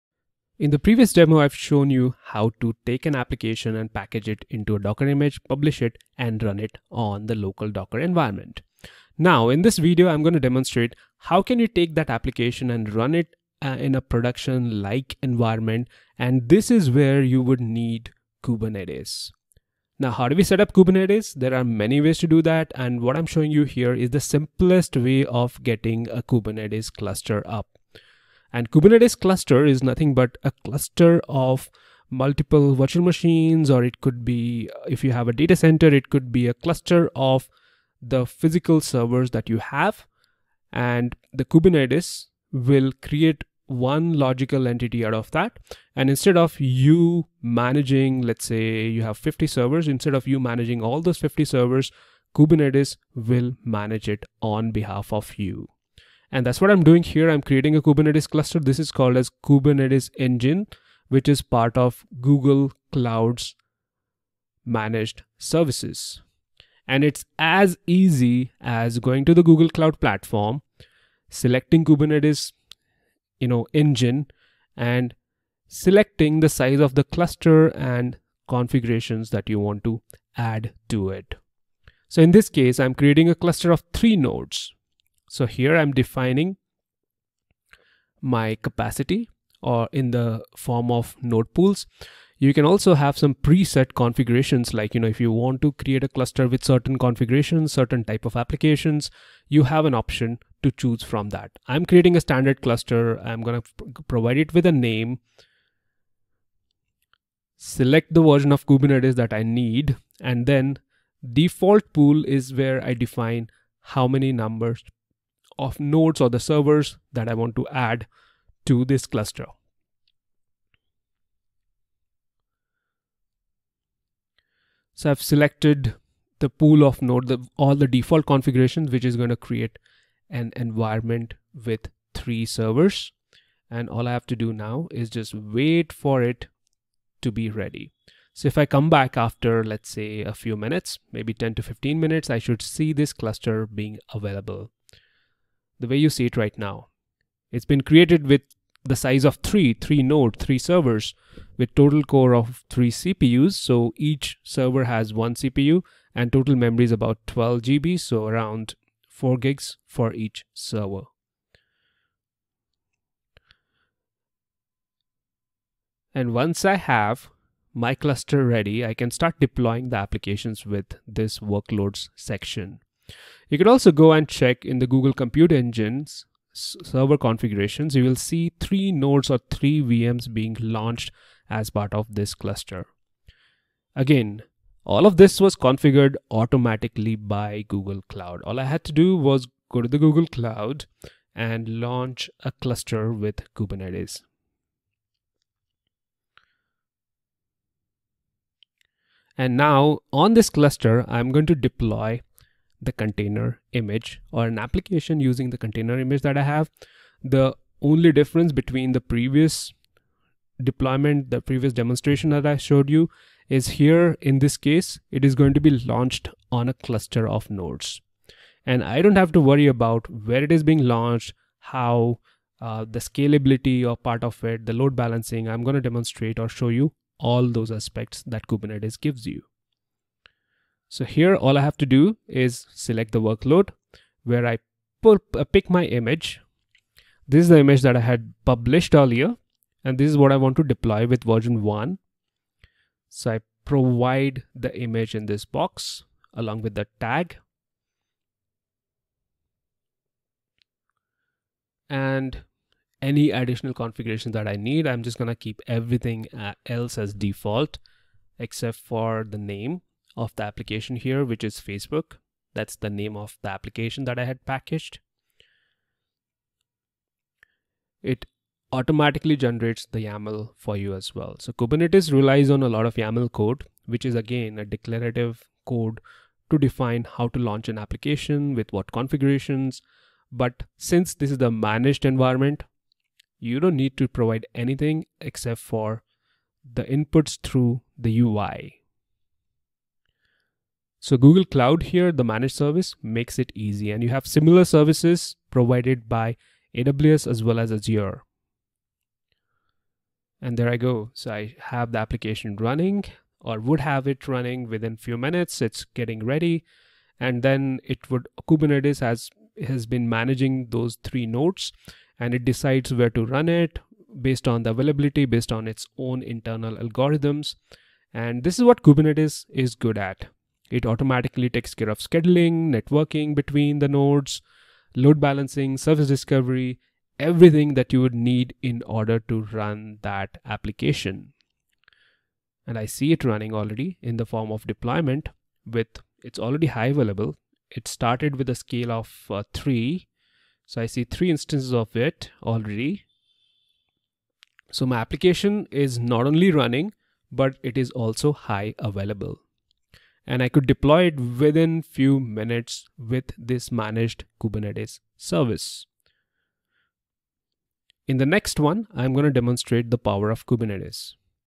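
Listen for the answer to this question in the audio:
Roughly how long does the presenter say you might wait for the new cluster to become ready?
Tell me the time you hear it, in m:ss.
2:21.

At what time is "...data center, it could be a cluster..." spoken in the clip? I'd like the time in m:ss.
0:35.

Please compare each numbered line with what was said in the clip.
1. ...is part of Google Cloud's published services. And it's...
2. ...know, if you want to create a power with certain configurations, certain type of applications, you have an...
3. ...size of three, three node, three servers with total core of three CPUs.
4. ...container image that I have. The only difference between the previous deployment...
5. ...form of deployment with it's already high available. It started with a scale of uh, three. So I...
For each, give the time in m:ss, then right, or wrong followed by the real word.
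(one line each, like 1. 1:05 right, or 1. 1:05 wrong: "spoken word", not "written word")
1. 1:01 wrong: "managed", not "published"
2. 1:34 wrong: "cluster", not "power"
3. 2:28 right
4. 3:25 right
5. 5:34 right.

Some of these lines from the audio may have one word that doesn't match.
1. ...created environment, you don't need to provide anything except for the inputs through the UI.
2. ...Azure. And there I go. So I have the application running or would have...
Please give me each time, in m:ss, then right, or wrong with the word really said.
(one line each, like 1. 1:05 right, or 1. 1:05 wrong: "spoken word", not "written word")
1. 4:41 wrong: "managed", not "created"
2. 4:57 right.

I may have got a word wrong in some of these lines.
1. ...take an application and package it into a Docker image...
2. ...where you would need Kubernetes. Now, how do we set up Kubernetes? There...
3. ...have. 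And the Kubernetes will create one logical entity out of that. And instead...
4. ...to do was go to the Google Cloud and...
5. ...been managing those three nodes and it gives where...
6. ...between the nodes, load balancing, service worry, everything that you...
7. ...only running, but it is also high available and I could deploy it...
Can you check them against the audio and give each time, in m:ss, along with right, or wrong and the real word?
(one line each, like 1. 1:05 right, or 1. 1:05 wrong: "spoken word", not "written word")
1. 0:02 right
2. 0:16 right
3. 0:39 right
4. 3:08 right
5. 5:09 wrong: "decides", not "gives"
6. 5:23 wrong: "discovery", not "worry"
7. 5:46 right.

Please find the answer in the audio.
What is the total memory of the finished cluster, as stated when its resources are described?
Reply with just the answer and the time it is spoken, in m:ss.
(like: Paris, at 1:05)
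12 GB, at 2:37.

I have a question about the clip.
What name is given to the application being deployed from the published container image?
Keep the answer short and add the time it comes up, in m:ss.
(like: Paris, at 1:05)
Facebook, at 4:21.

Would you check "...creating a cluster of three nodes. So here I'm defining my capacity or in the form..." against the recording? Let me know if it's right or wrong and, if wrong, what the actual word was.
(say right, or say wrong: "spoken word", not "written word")
right.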